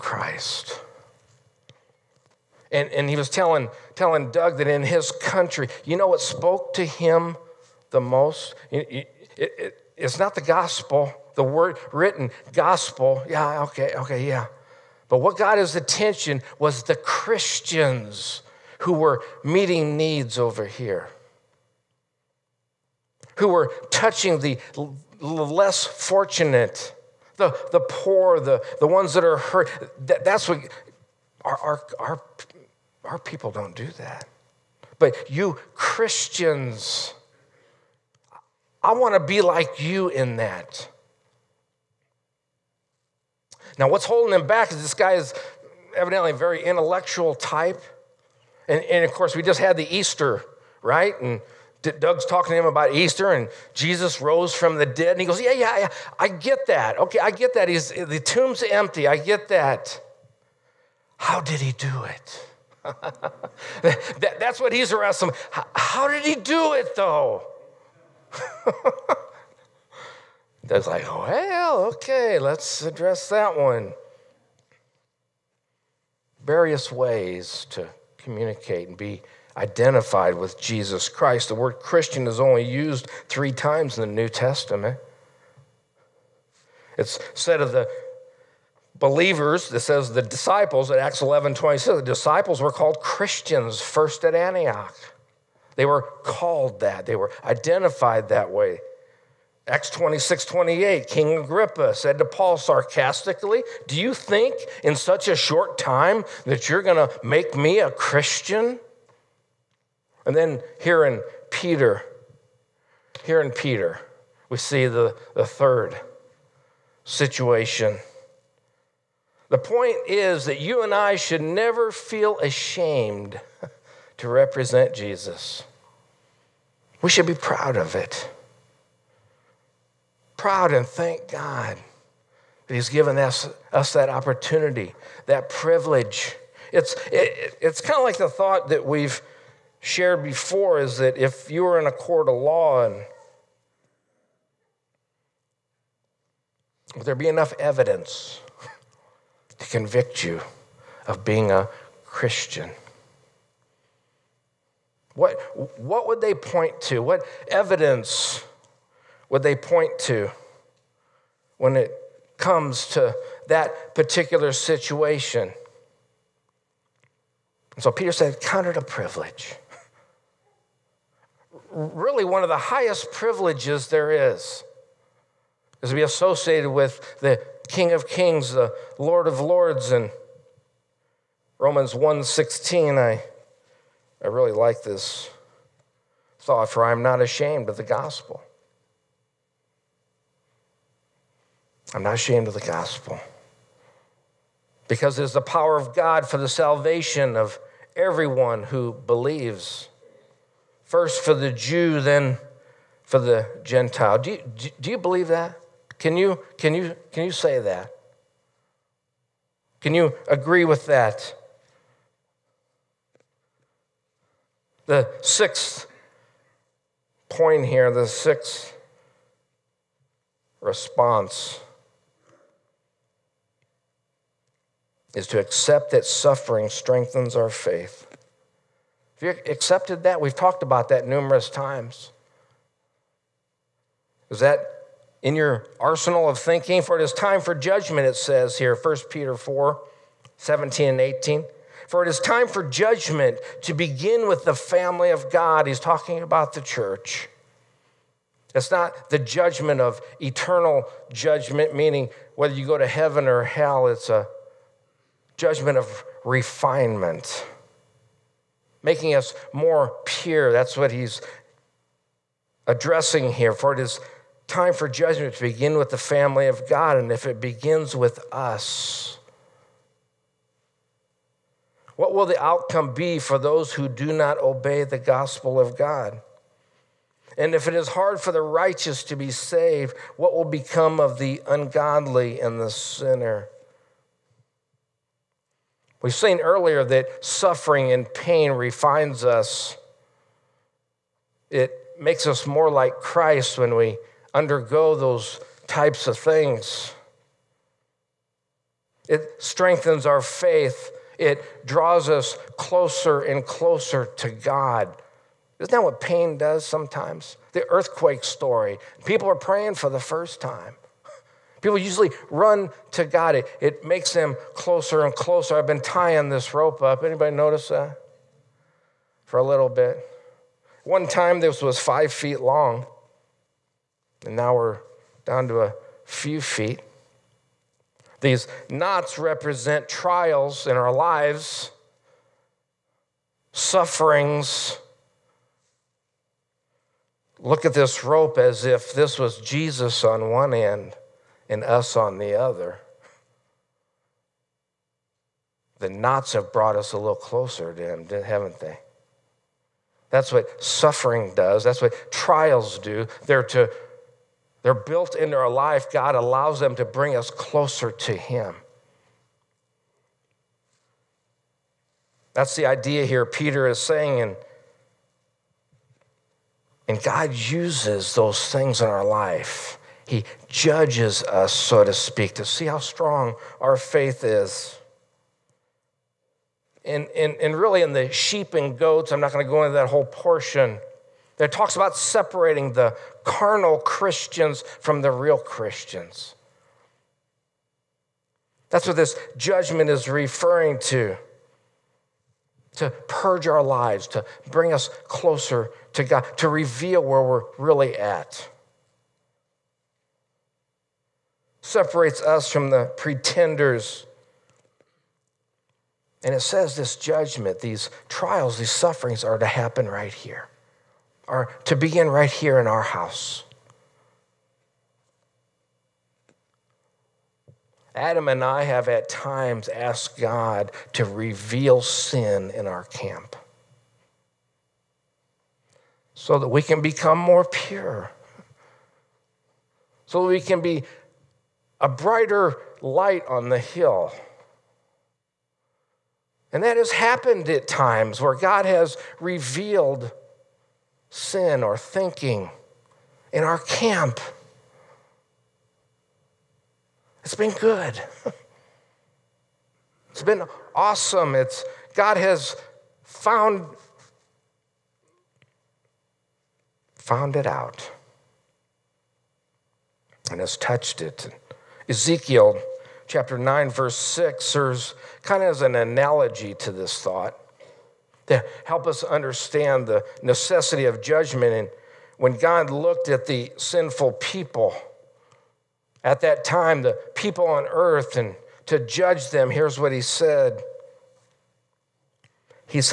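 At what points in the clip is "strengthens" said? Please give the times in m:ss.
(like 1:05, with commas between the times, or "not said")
3:46, 4:59.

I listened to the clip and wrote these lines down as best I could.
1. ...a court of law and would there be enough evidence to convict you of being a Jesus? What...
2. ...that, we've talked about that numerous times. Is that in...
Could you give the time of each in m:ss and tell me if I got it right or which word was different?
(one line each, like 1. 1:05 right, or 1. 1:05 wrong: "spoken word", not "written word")
1. 2:21 wrong: "Christian", not "Jesus"
2. 3:50 right.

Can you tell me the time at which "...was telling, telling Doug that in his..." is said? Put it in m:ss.
0:03.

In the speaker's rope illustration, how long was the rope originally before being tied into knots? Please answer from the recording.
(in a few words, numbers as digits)
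5 feet.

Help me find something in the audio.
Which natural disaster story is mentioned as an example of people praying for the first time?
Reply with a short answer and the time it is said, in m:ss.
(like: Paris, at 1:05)
Earthquake, at 5:07.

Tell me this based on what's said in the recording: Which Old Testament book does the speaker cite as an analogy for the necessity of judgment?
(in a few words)
Ezekiel.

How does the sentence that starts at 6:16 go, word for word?
And, and, and really, in the sheep and goats, I'm not going to go into that whole portion.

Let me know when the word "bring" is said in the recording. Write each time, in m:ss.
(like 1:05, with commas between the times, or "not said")
5:56, 6:34.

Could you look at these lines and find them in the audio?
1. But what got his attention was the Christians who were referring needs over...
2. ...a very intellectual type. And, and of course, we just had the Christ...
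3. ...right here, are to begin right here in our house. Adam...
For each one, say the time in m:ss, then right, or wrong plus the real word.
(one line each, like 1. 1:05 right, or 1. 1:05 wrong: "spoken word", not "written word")
1. 0:15 wrong: "meeting", not "referring"
2. 0:46 wrong: "Easter", not "Christ"
3. 6:49 right.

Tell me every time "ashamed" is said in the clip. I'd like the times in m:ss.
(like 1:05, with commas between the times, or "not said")
2:02, 3:07, 3:12.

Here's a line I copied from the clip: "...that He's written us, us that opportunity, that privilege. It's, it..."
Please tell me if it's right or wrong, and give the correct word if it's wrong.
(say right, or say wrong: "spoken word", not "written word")
wrong: "given", not "written".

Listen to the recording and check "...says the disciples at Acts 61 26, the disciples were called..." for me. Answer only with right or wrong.
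wrong.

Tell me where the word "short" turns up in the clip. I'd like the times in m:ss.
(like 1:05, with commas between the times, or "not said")
1:45.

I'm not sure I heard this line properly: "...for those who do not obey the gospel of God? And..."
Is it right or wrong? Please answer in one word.
right.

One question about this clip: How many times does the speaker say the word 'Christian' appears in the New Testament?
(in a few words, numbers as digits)
3.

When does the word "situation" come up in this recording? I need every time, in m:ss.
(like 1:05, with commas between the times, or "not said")
1:57, 2:44.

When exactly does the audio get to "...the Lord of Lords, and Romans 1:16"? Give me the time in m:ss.
2:58.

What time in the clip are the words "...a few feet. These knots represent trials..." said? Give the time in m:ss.
5:25.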